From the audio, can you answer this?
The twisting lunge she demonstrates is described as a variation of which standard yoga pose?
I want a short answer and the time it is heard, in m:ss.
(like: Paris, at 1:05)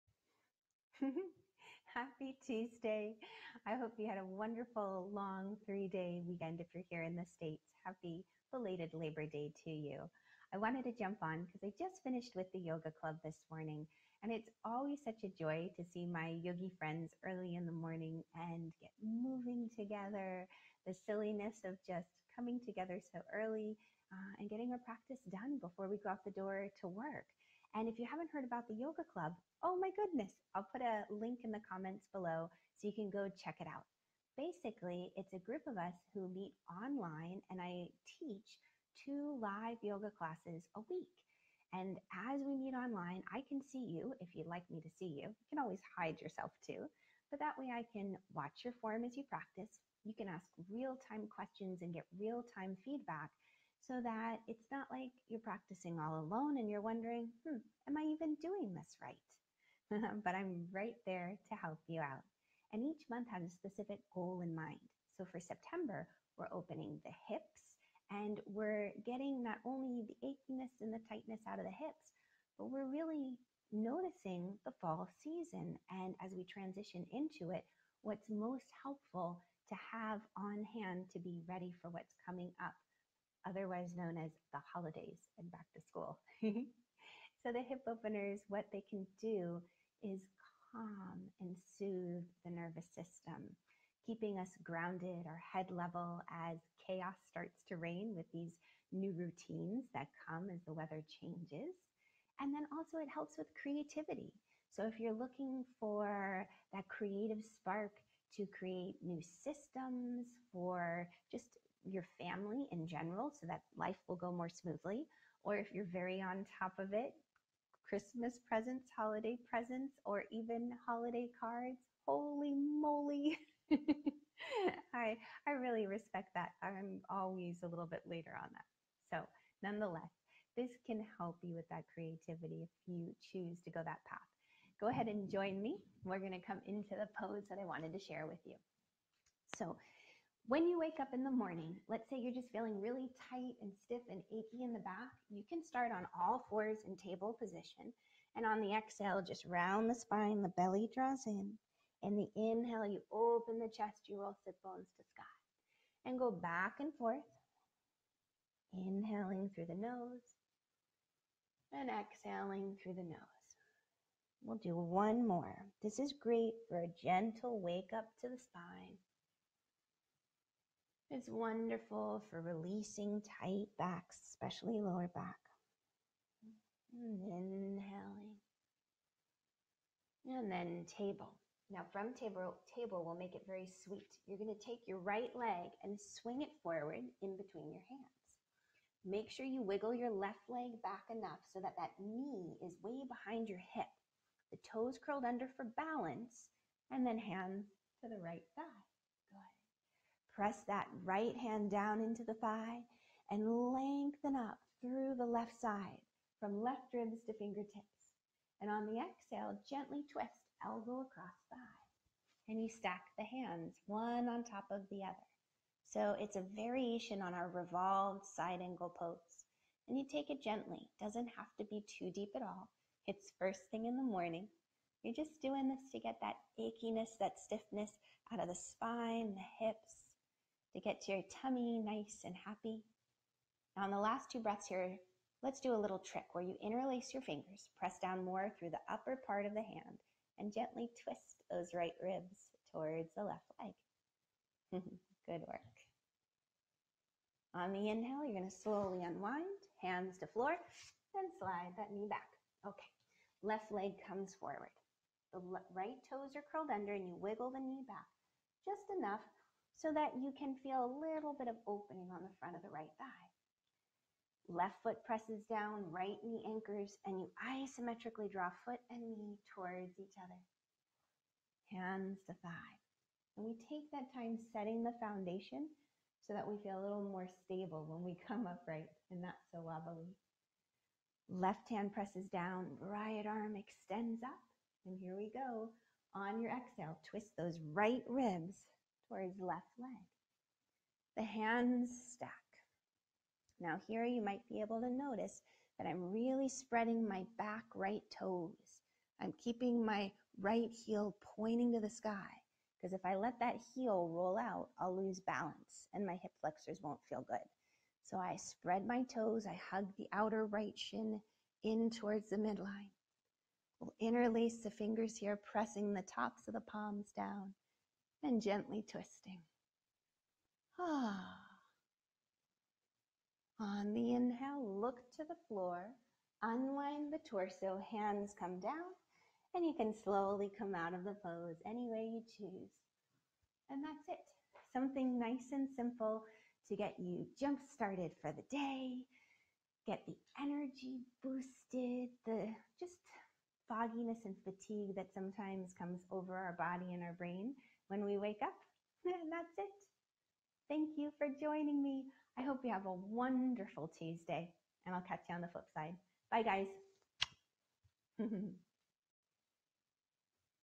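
Revolved side angle pose, at 3:37.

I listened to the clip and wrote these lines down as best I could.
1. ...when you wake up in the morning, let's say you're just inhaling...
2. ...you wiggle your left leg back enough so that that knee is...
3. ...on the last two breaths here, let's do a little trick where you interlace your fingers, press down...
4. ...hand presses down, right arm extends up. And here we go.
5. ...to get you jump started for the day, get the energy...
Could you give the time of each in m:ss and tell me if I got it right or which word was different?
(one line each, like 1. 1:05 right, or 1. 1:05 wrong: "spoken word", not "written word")
1. 2:20 wrong: "feeling", not "inhaling"
2. 3:09 right
3. 3:53 right
4. 4:41 right
5. 5:36 right.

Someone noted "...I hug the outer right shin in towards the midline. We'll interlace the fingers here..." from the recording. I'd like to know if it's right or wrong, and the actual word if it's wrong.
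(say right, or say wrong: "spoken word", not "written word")
right.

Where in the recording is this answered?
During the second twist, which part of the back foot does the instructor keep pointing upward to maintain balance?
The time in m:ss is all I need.
5:00.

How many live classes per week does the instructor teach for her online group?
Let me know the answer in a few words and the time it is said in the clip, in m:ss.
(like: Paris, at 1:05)
2, at 0:39.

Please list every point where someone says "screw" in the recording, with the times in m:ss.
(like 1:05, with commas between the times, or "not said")
not said.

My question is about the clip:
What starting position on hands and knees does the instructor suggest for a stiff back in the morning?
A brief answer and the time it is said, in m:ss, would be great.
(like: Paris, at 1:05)
Table position, at 2:26.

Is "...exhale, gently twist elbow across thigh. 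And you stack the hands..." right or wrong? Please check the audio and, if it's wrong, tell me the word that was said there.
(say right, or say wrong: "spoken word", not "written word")
right.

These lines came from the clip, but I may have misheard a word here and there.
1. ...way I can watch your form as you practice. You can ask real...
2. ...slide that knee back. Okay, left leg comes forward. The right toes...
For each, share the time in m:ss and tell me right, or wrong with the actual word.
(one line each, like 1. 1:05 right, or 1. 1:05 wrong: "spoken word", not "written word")
1. 0:47 right
2. 4:11 right.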